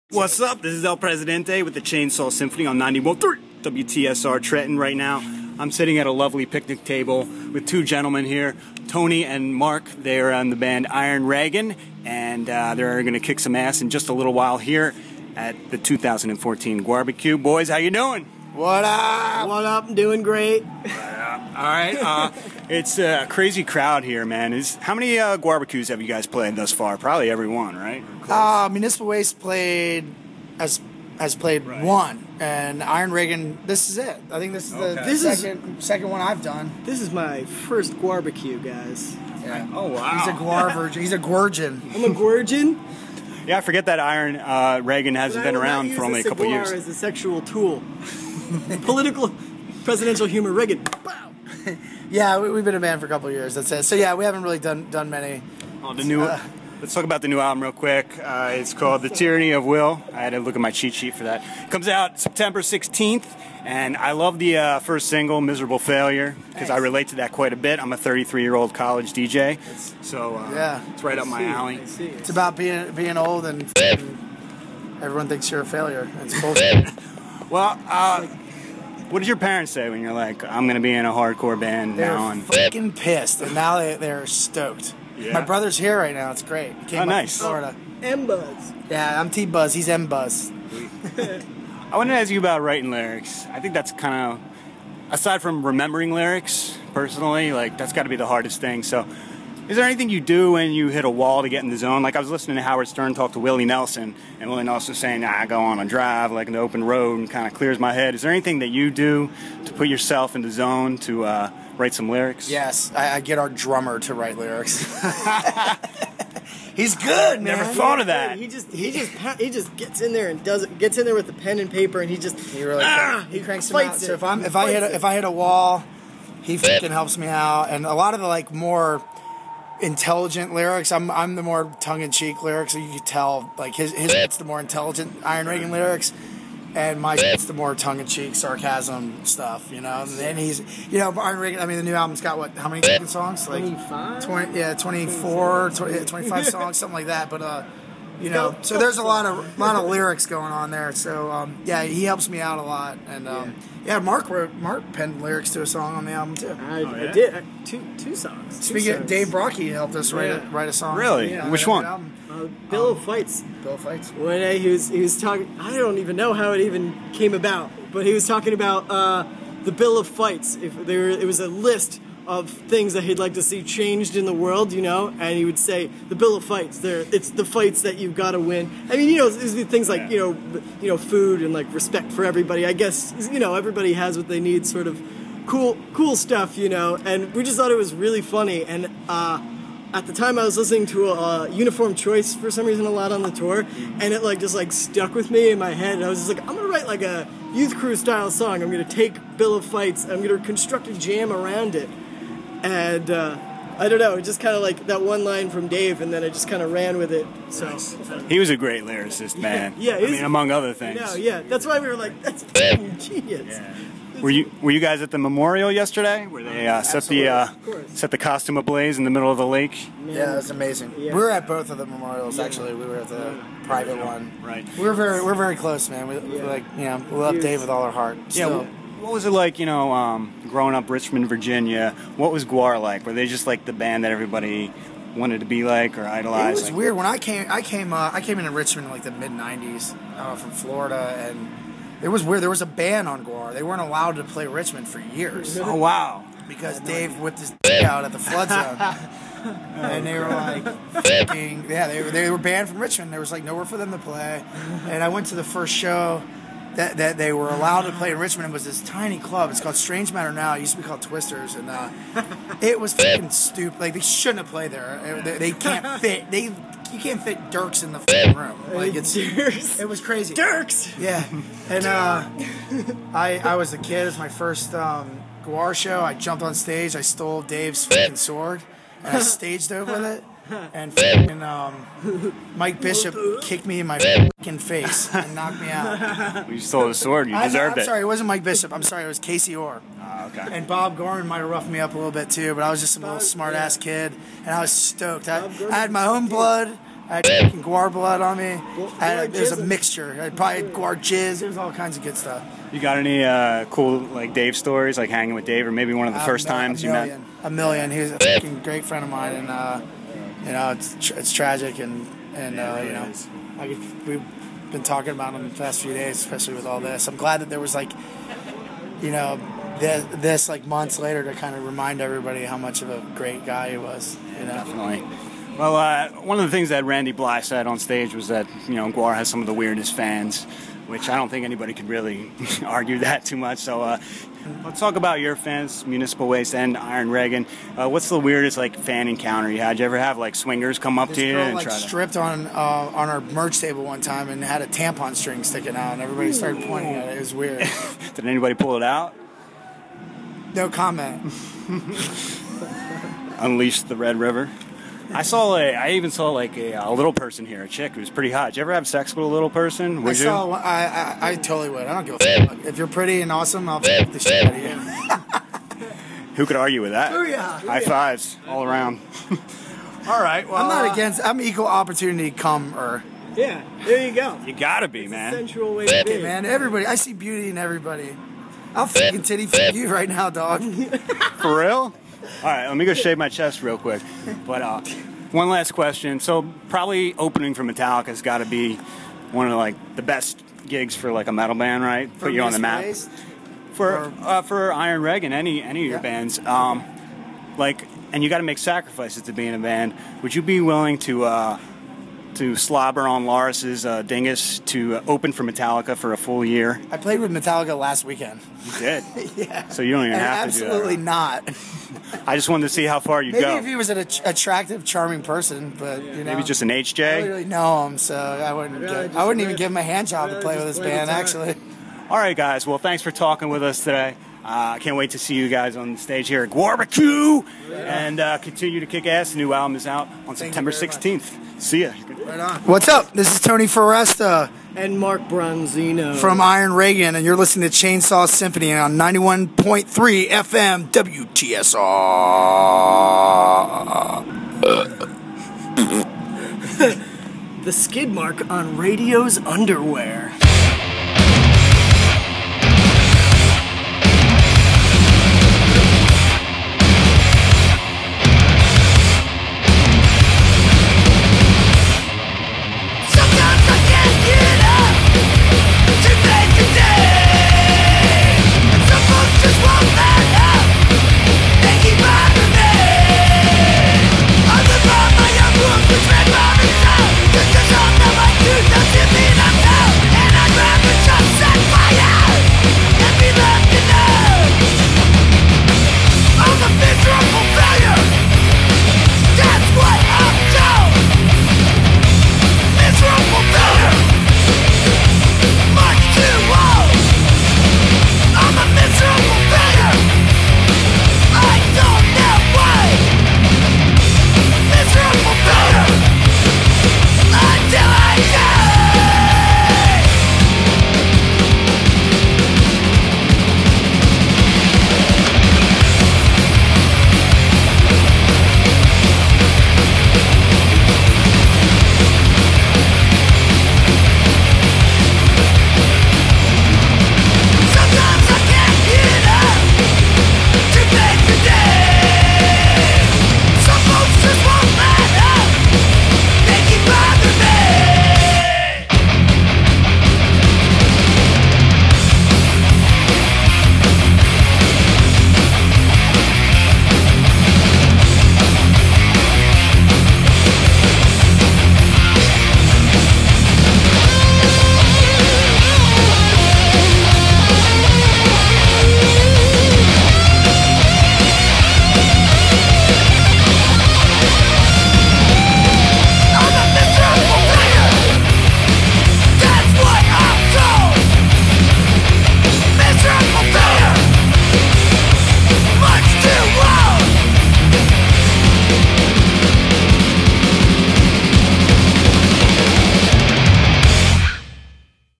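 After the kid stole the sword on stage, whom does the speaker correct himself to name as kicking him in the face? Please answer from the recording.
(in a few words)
Casey Orr.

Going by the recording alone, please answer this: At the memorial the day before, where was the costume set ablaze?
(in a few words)
in the middle of the lake.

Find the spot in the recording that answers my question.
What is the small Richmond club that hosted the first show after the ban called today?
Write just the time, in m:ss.
4:19.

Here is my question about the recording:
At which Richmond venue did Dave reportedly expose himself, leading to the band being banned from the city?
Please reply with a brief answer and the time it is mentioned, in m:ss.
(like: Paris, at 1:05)
the Flood Zone, at 4:08.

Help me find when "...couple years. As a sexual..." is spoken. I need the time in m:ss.
0:46.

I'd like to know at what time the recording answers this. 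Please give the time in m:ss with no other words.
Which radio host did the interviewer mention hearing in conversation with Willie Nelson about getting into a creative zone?
1:42.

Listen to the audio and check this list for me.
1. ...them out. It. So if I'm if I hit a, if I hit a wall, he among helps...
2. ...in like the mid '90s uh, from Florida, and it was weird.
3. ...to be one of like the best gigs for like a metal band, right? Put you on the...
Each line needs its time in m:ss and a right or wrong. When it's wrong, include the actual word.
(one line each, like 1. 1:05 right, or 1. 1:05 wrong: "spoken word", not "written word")
1. 2:03 wrong: "fucking", not "among"
2. 3:58 right
3. 6:28 right.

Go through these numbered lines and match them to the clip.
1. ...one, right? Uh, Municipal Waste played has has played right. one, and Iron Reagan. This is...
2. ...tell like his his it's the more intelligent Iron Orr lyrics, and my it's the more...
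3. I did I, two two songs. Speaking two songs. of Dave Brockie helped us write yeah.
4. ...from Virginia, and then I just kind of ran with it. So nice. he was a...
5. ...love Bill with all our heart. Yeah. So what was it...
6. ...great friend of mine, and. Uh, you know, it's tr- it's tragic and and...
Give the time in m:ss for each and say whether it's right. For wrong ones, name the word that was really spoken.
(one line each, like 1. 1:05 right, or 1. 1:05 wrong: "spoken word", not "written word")
1. 0:27 right
2. 2:13 wrong: "Reagan", not "Orr"
3. 2:37 right
4. 3:25 wrong: "Dave", not "Virginia"
5. 3:47 wrong: "Dave", not "Bill"
6. 5:08 right.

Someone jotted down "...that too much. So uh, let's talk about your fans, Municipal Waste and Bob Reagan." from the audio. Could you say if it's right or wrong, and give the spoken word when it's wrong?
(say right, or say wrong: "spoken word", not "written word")
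wrong: "Iron", not "Bob".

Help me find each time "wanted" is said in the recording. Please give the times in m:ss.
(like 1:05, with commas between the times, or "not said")
1:31, 3:55, 6:52.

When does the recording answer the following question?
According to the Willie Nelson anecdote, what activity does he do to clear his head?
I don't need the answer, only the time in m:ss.
1:45.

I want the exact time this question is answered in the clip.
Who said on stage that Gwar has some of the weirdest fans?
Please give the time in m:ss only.
5:26.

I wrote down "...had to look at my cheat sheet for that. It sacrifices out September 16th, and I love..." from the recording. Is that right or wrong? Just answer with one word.
wrong.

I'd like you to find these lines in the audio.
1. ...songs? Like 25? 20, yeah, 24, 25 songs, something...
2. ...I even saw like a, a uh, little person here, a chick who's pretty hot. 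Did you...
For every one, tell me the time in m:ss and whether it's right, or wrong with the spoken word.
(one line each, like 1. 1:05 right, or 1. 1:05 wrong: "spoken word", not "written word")
1. 2:23 right
2. 5:55 right.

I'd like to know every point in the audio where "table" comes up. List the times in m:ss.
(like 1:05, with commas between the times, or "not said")
0:06, 5:43.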